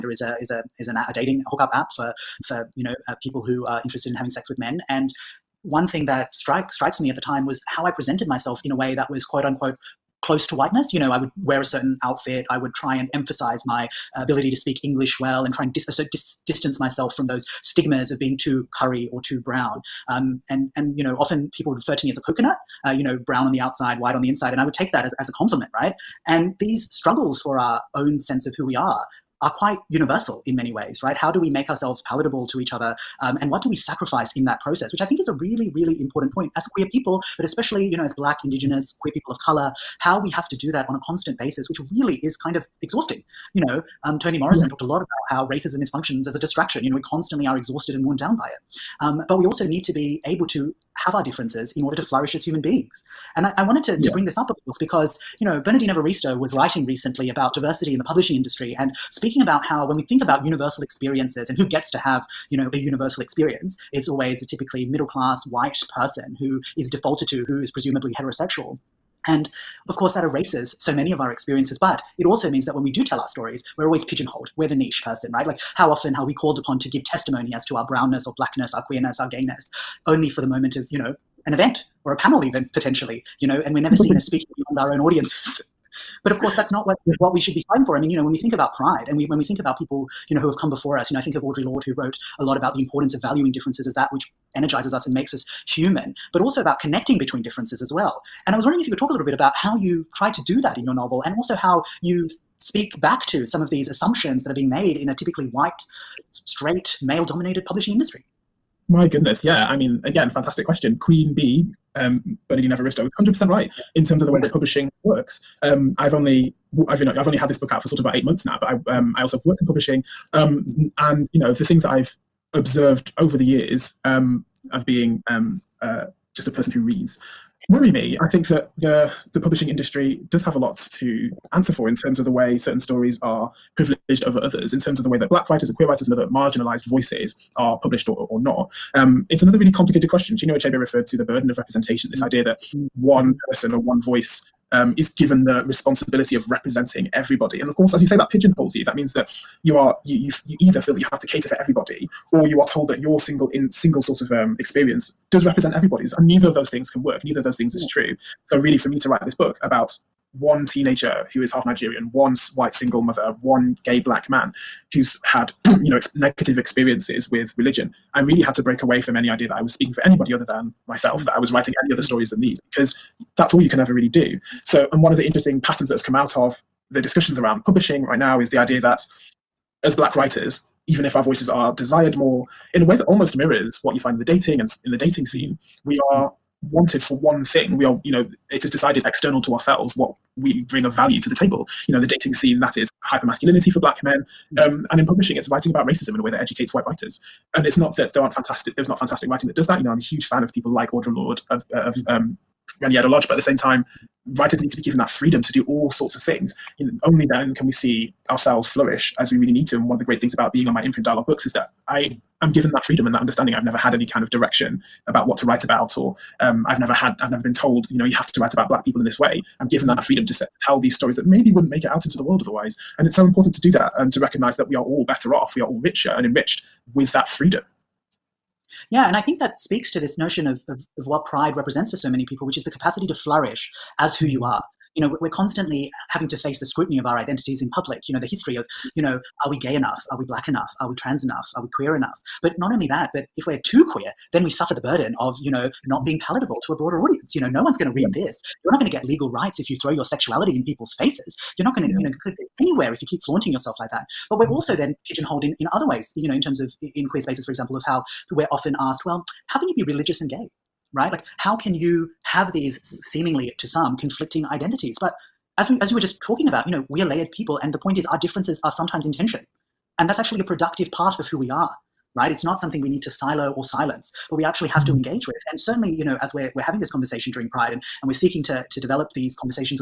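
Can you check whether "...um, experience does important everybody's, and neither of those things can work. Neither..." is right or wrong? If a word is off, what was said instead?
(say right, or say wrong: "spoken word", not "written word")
wrong: "represent", not "important".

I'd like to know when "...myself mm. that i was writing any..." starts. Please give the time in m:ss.
2:50.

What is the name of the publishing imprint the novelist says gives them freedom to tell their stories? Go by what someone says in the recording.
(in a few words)
Dialogue Books.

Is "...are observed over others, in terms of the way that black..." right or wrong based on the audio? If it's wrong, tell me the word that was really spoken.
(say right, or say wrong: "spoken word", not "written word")
wrong: "privileged", not "observed".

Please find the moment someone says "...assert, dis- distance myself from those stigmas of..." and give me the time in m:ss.
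0:15.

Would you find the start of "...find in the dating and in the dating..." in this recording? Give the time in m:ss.
3:03.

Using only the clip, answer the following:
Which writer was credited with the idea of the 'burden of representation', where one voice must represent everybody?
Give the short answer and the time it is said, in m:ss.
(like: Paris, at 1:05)
Chinua Achebe, at 2:20.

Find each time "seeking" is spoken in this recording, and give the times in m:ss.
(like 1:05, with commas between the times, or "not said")
4:38.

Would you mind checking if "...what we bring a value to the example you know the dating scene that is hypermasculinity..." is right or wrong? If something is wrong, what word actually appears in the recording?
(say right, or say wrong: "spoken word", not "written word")
wrong: "table", not "example".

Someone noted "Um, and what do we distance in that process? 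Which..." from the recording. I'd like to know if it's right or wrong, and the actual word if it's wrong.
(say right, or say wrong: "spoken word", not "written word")
wrong: "sacrifice", not "distance".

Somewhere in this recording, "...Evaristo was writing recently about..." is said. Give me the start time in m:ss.
0:55.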